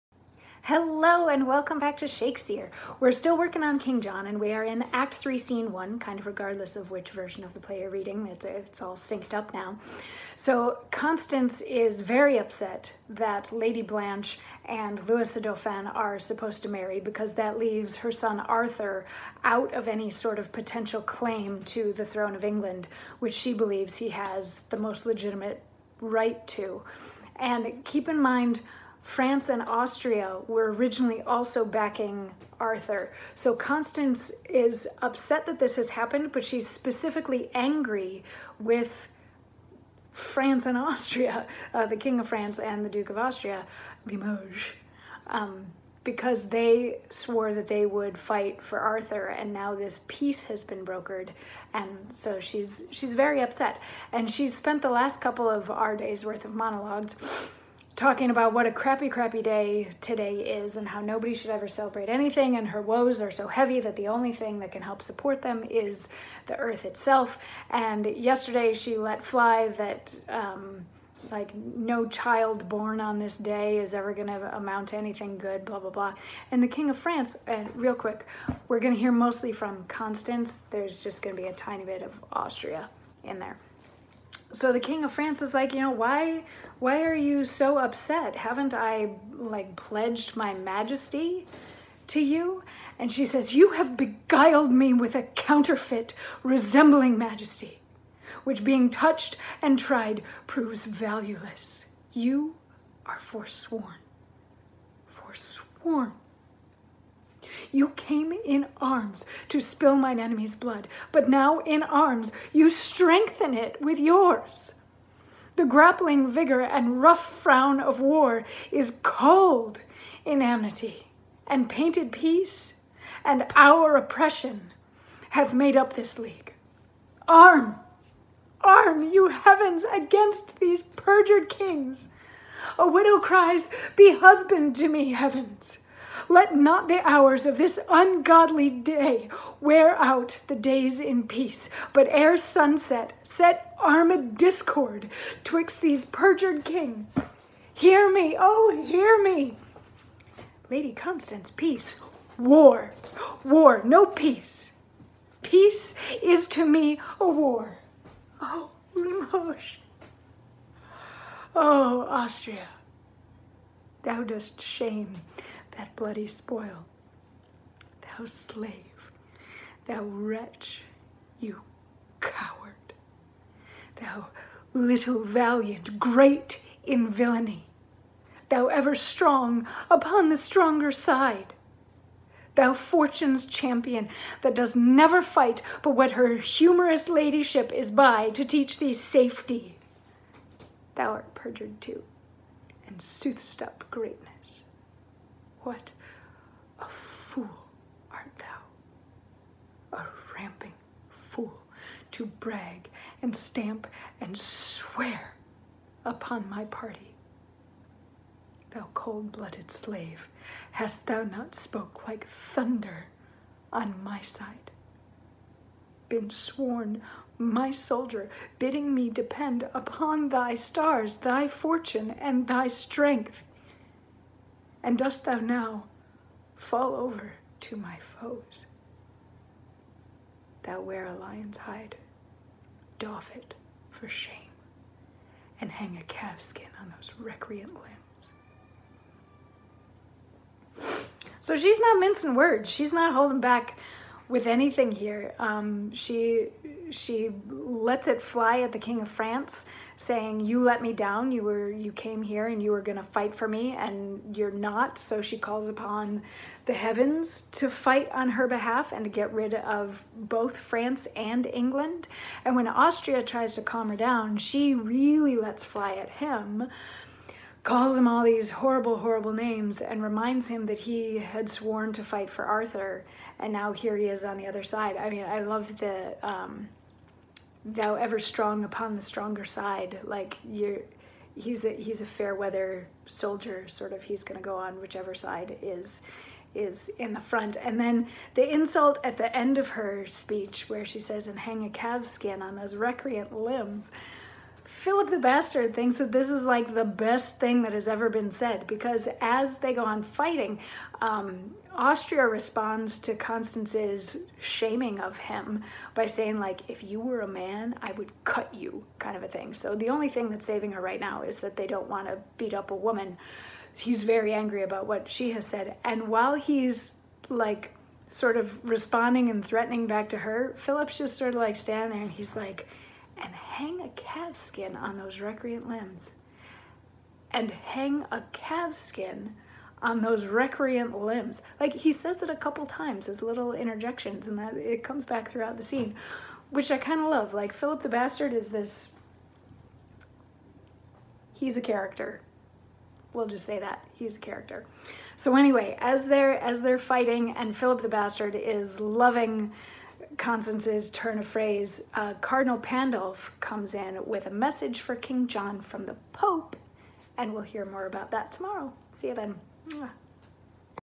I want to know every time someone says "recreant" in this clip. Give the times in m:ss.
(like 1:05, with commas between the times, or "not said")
3:57, 4:52, 5:25, 5:30.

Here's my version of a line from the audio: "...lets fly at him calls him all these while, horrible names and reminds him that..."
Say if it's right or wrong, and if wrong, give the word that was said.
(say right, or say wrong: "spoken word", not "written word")
wrong: "horrible", not "while".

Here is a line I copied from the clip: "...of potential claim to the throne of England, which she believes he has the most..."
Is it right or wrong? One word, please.
right.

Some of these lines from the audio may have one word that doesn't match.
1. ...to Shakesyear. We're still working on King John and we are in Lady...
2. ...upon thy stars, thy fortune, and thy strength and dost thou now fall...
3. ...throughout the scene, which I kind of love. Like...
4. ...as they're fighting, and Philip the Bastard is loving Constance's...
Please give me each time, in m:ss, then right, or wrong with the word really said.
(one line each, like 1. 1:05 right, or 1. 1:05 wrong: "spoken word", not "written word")
1. 0:01 wrong: "Act", not "Lady"
2. 3:39 right
3. 5:35 right
4. 5:46 right.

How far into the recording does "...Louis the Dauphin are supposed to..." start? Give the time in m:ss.
0:15.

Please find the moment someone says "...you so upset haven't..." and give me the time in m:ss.
1:27.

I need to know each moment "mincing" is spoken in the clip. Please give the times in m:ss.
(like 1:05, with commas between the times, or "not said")
4:01.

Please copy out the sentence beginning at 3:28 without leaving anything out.
Thou cold-blooded slave, hast thou not spoke like thunder on my side?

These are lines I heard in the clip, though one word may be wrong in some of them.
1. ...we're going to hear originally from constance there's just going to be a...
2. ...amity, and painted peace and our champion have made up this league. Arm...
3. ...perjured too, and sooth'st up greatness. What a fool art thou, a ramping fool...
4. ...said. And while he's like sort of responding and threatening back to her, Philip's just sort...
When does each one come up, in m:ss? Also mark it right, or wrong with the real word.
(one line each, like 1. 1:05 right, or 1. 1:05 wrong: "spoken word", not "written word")
1. 1:18 wrong: "mostly", not "originally"
2. 2:00 wrong: "oppression", not "champion"
3. 3:11 right
4. 5:15 right.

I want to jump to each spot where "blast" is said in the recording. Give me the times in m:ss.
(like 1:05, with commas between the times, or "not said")
not said.